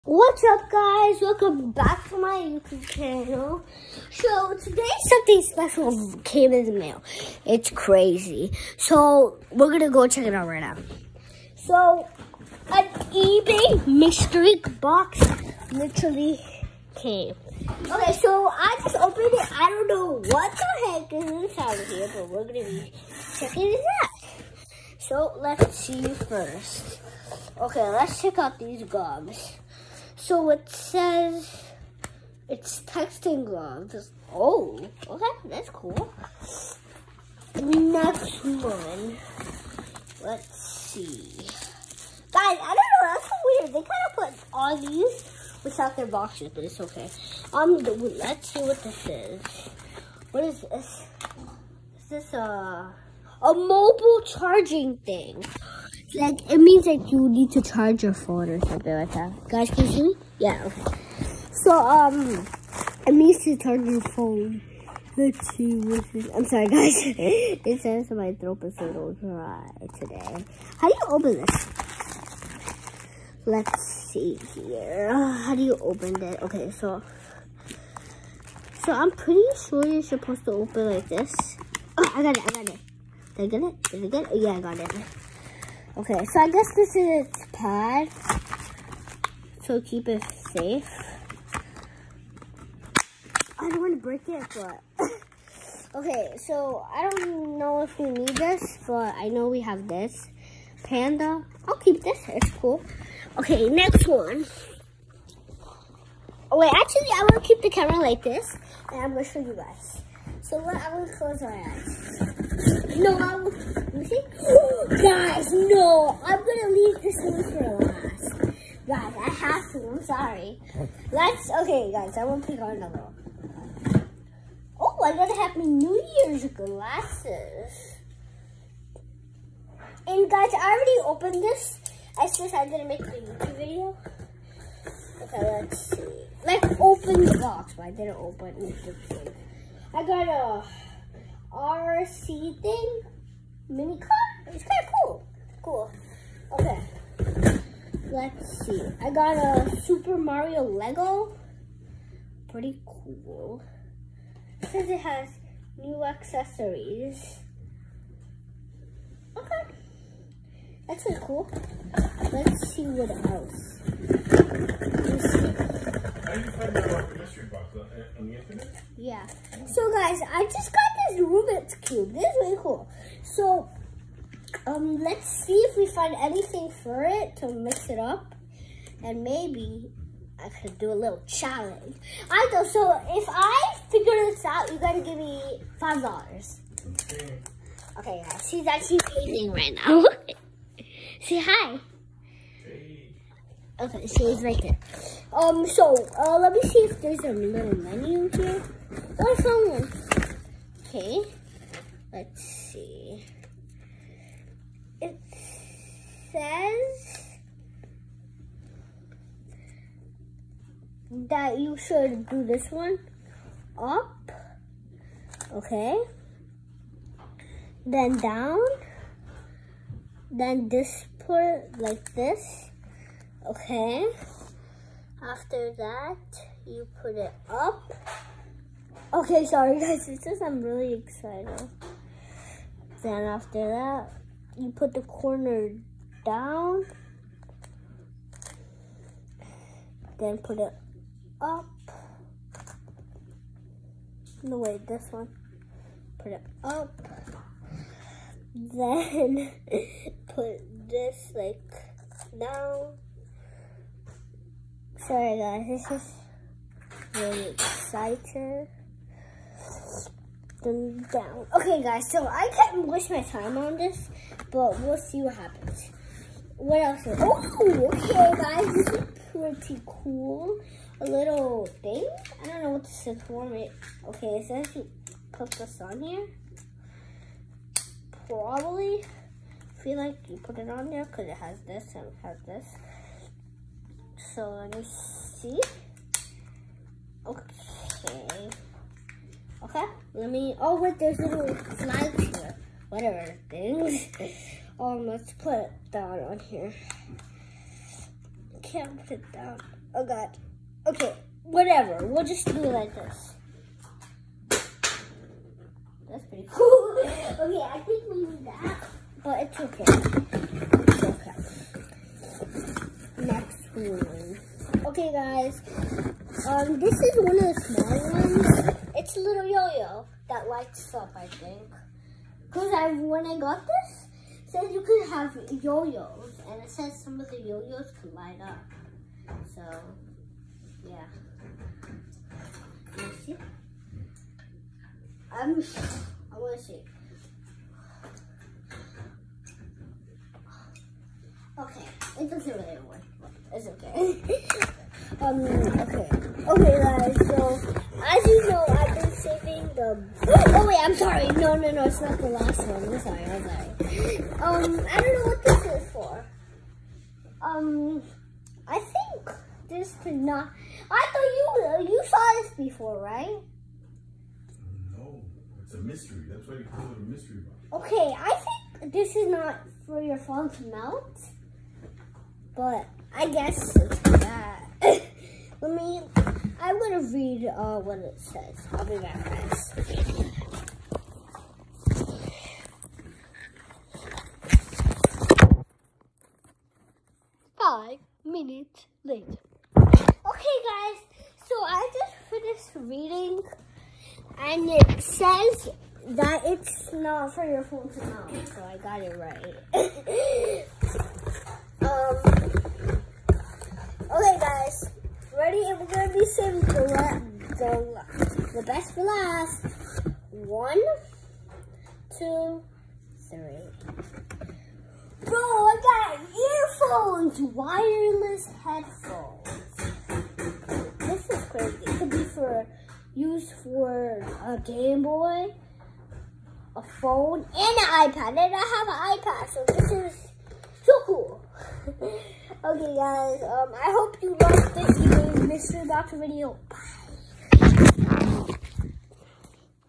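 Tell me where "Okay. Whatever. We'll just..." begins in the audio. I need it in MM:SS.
05:00.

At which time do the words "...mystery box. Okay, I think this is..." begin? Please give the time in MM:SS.
06:07.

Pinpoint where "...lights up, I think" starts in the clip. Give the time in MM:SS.
05:20.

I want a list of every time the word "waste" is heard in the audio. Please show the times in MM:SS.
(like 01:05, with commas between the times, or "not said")
04:22.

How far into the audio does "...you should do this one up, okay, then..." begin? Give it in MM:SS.
03:31.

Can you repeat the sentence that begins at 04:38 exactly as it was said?
Probably feel like you put it on there because it has this and it has this.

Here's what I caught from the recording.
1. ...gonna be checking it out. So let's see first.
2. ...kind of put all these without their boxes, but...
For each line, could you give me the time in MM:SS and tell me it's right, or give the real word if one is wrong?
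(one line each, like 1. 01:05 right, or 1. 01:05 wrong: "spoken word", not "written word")
1. 00:22 right
2. 00:43 right.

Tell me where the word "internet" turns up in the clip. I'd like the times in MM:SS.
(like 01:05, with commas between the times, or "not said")
02:48.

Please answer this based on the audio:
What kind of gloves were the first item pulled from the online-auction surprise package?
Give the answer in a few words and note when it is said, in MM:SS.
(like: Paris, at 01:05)
texting gloves, at 00:32.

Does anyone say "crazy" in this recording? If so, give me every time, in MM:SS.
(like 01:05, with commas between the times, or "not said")
00:07, 07:01.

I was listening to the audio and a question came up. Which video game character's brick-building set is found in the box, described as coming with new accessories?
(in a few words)
Super Mario.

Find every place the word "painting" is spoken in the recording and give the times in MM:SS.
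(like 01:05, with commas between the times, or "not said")
03:09.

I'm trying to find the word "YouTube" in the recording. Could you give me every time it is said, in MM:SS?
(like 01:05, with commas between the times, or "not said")
00:02, 02:13.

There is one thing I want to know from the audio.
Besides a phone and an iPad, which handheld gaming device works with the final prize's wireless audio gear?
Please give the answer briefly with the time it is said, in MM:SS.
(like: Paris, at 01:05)
Game Boy, at 07:04.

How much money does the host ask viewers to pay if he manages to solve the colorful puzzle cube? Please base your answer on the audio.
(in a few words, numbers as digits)
$5.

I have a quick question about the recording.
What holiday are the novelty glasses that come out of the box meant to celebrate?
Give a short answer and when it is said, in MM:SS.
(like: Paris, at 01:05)
New Year's, at 02:05.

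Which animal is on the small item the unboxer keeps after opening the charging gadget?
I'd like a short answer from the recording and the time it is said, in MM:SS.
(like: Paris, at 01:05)
Panda, at 01:40.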